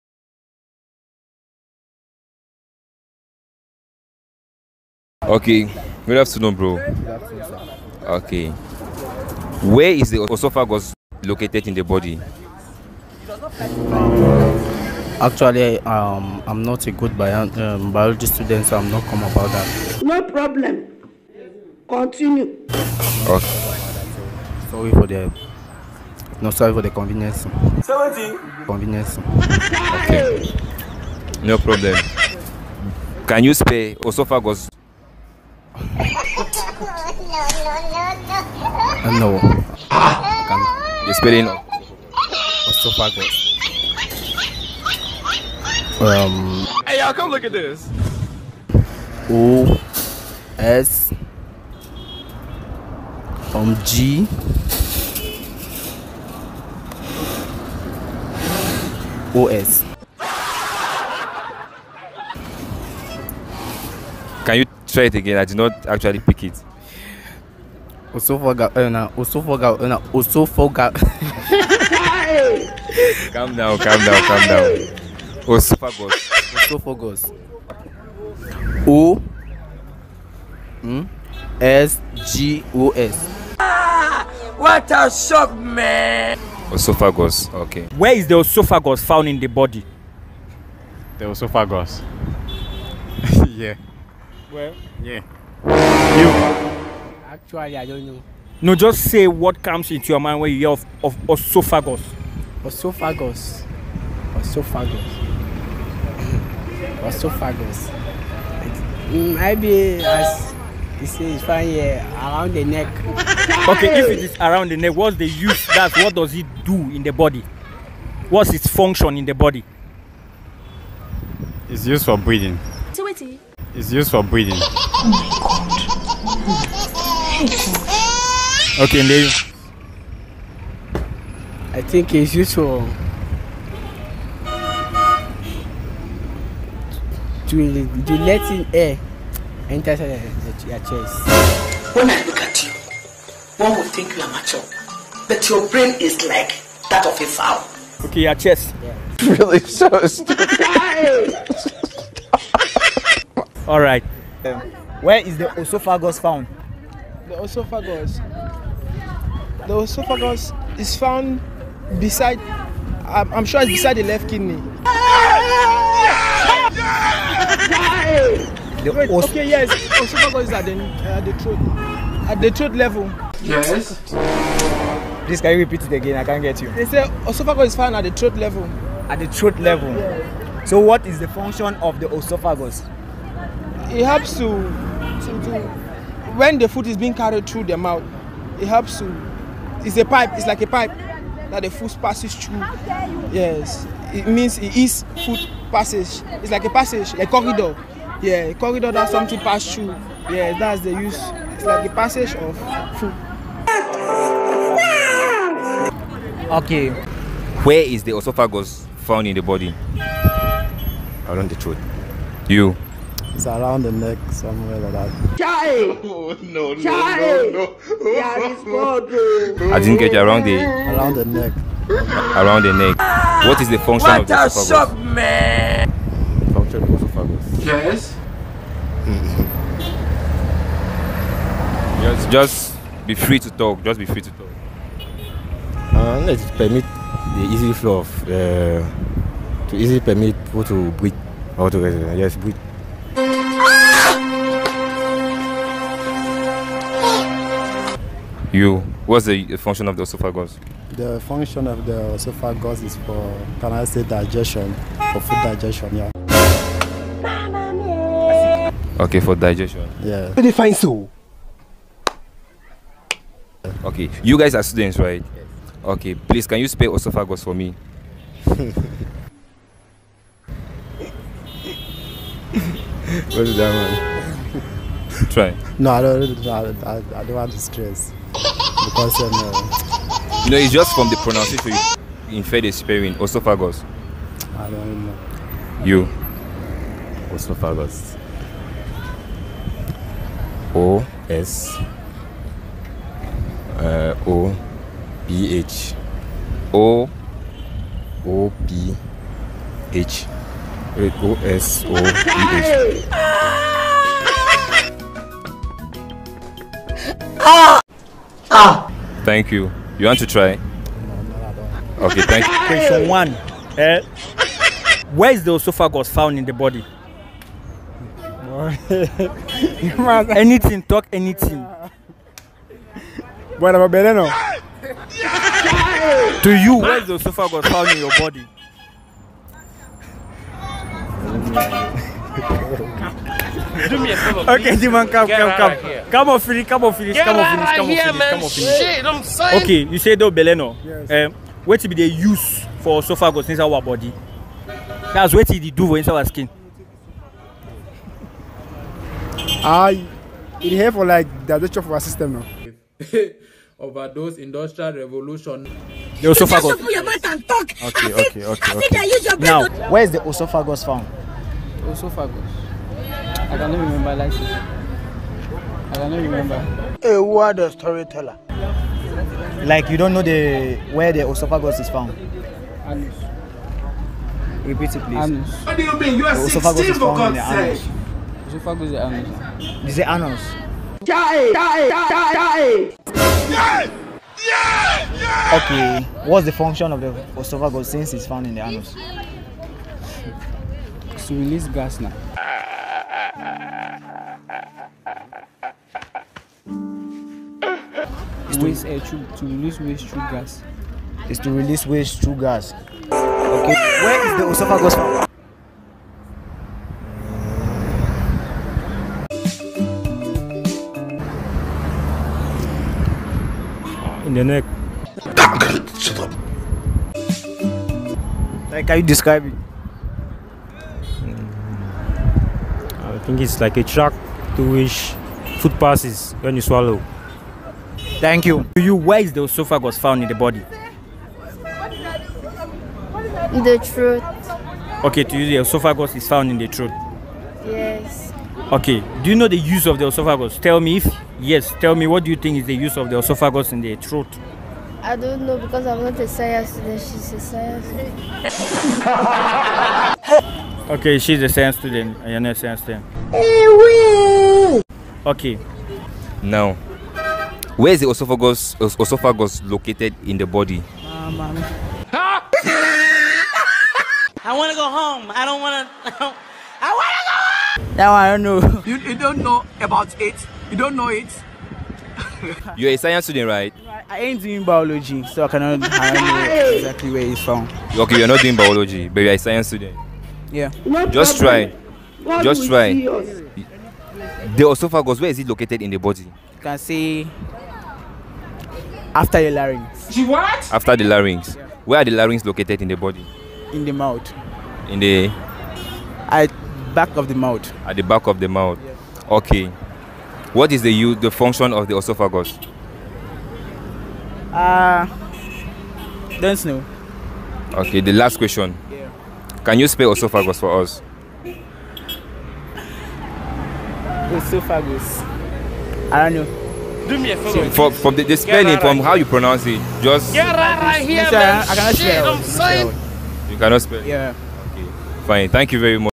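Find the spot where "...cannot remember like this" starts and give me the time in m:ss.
6:03.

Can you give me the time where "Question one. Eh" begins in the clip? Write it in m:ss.
5:12.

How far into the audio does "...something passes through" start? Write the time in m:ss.
3:19.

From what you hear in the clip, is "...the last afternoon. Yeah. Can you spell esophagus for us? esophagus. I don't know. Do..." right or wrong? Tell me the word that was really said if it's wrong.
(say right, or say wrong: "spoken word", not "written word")
wrong: "question", not "afternoon".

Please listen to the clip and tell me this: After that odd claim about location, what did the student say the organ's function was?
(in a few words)
To release gas.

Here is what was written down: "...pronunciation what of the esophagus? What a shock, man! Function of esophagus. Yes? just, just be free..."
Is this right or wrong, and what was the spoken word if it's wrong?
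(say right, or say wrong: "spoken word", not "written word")
wrong: "function", not "pronunciation".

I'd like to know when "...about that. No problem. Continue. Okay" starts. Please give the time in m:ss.
0:19.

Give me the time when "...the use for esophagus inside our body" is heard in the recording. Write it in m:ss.
5:41.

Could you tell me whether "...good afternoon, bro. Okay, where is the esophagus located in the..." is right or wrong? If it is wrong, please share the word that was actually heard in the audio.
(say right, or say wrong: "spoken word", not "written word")
right.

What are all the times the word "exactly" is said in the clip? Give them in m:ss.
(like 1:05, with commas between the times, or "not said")
7:55.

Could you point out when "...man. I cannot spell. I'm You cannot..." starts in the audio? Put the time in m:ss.
8:41.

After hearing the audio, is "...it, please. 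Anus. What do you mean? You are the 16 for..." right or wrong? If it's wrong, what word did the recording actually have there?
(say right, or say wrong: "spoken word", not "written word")
right.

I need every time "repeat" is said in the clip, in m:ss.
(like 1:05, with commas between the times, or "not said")
2:55, 6:14.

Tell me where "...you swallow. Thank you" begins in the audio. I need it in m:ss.
7:06.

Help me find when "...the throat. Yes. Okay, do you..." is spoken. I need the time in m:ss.
7:16.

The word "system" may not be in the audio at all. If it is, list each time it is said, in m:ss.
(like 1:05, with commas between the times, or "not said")
5:52.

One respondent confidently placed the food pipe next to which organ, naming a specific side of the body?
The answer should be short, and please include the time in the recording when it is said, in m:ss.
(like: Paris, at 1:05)
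Left kidney, at 2:43.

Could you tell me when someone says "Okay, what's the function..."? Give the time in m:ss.
6:25.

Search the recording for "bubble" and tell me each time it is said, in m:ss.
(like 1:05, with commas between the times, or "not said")
not said.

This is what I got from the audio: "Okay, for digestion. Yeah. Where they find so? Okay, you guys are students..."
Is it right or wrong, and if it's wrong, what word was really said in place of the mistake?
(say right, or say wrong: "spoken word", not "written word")
right.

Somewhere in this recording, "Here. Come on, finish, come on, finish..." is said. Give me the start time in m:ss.
5:35.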